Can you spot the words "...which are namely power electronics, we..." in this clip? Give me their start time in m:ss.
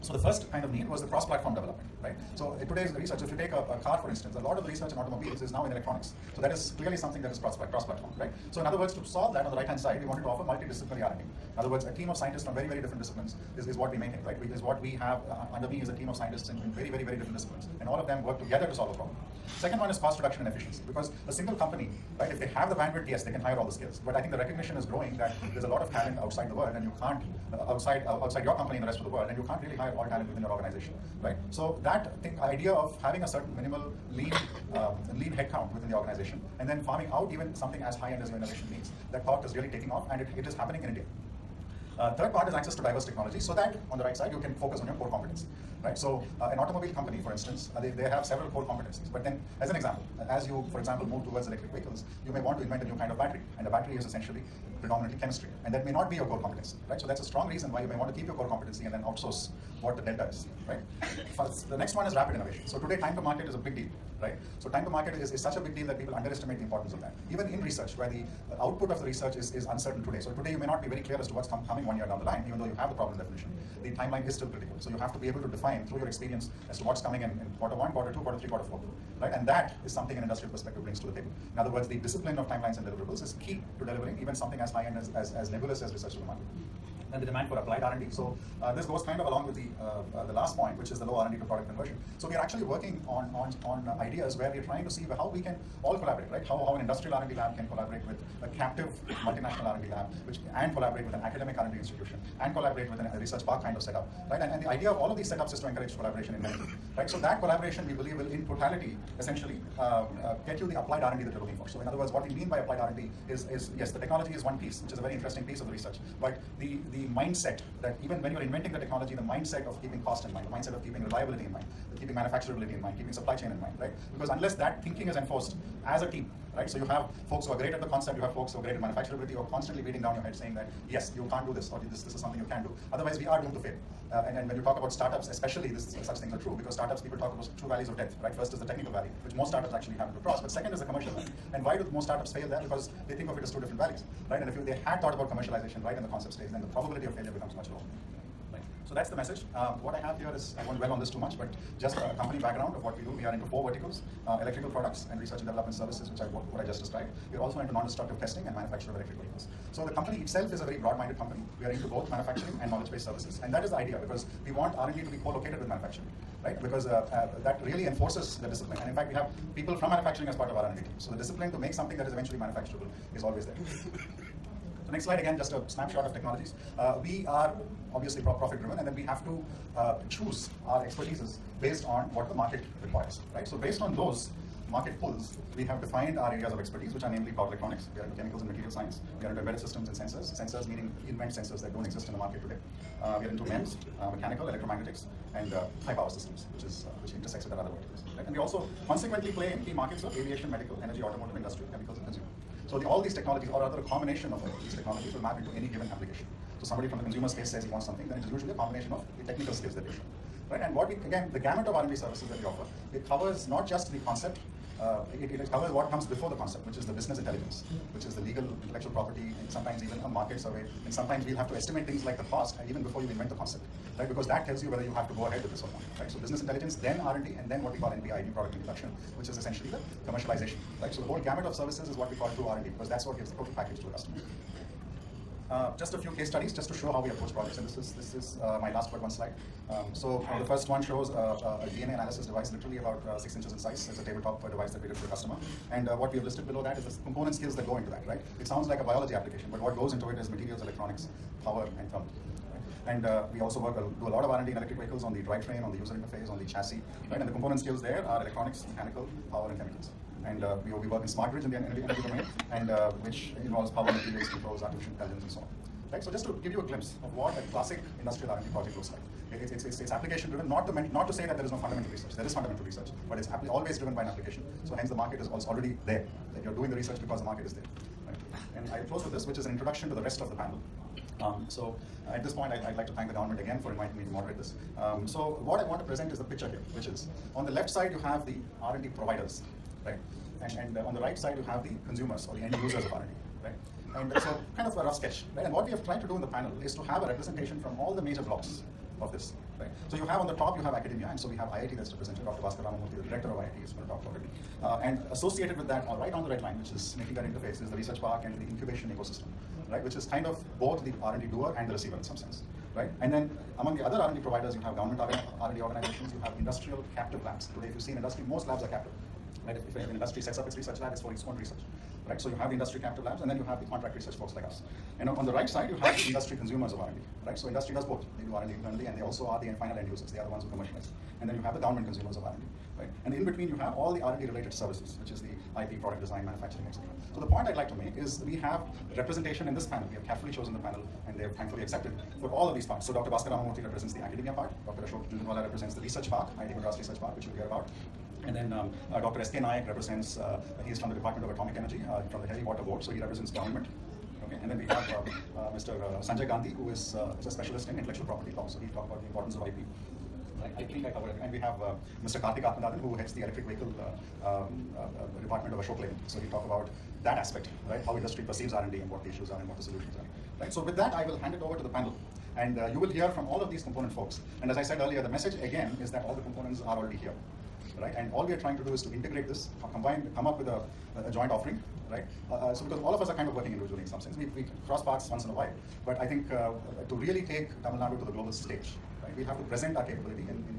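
3:06.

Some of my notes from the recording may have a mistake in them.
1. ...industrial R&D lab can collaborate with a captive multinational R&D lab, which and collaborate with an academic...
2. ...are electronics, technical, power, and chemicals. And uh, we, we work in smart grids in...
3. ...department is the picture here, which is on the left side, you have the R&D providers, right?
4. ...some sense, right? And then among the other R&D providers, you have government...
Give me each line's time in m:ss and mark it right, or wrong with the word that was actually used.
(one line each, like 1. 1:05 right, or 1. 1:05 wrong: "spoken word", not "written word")
1. 1:36 right
2. 4:18 wrong: "mechanical", not "technical"
3. 4:45 wrong: "present", not "department"
4. 5:12 right.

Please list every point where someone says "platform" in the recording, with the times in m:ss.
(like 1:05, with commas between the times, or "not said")
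0:01, 0:07.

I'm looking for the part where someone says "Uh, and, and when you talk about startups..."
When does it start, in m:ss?
2:14.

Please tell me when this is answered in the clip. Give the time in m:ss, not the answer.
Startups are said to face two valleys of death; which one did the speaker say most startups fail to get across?
2:20.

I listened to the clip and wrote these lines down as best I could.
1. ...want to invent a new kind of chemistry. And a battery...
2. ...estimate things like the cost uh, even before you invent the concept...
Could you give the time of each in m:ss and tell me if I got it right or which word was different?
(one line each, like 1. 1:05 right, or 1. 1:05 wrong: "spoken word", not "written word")
1. 0:52 wrong: "battery", not "chemistry"
2. 3:41 right.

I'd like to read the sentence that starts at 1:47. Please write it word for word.
So that collaboration, we believe, will in totality, essentially, uh, uh, get you the applied R&D that you're looking for.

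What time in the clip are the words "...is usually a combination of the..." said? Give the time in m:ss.
3:28.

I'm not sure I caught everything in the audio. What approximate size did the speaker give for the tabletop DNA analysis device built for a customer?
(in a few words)
6 inches.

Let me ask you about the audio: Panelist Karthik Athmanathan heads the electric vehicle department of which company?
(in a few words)
Ashok Leyland.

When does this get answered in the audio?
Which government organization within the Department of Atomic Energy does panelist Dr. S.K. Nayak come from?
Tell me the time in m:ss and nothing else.
5:52.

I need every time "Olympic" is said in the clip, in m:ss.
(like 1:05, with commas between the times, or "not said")
not said.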